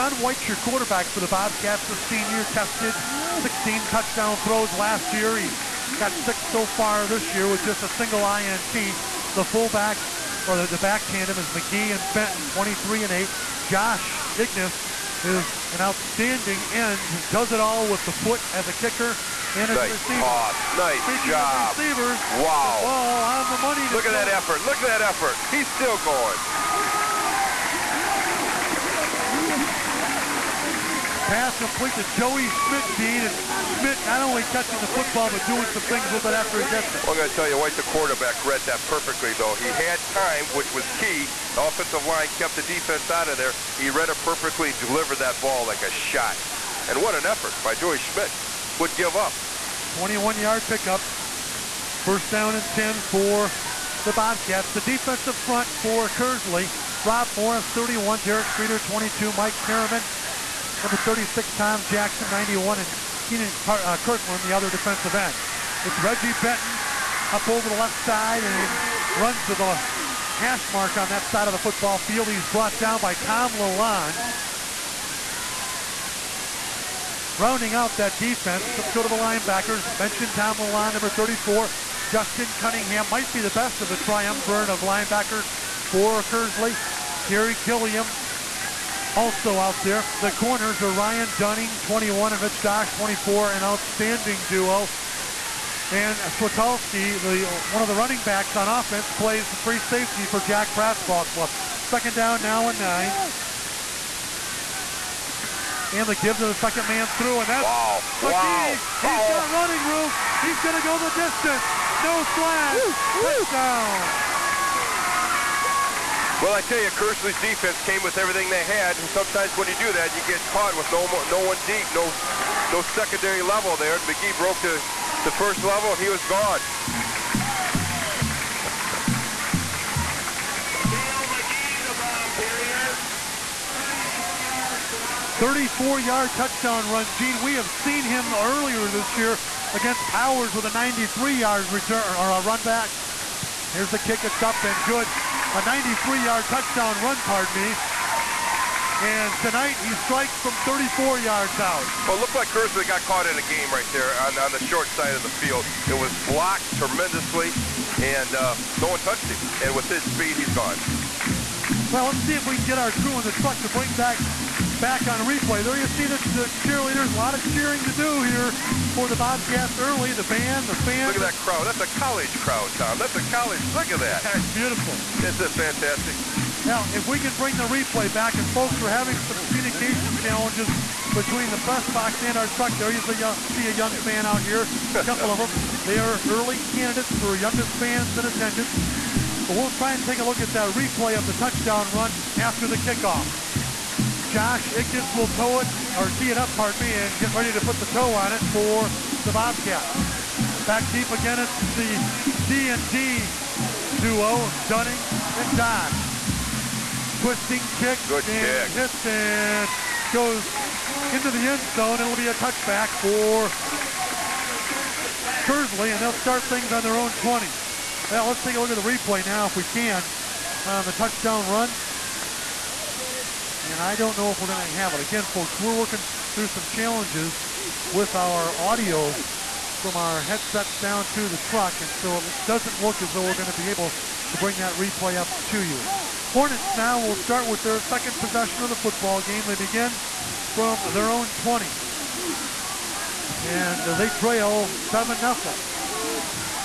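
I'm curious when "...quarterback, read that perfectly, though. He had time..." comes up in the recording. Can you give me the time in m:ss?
0:37.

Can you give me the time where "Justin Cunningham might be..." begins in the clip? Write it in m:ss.
1:22.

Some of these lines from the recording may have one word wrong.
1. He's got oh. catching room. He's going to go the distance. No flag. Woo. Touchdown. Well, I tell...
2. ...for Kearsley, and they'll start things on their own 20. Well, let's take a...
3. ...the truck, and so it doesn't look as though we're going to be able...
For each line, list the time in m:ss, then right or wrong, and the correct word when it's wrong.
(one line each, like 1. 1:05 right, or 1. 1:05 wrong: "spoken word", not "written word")
1. 1:49 wrong: "running", not "catching"
2. 3:32 right
3. 3:51 right.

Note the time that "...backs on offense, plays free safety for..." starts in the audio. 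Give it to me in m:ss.
1:38.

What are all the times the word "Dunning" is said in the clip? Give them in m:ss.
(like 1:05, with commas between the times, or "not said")
1:31, 3:24.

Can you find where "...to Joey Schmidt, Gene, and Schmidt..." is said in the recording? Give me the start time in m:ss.
0:31.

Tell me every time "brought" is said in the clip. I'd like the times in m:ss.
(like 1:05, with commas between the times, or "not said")
1:12.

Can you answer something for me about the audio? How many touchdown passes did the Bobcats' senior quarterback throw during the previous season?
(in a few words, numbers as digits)
16.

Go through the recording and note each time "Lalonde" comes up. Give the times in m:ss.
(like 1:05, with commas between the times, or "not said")
1:13, 1:20.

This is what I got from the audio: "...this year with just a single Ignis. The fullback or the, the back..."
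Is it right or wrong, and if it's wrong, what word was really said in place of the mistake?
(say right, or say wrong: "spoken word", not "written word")
wrong: "INT", not "Ignis".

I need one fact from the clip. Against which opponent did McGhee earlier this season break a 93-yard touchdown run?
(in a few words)
Powers.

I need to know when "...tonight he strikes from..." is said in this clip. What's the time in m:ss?
2:29.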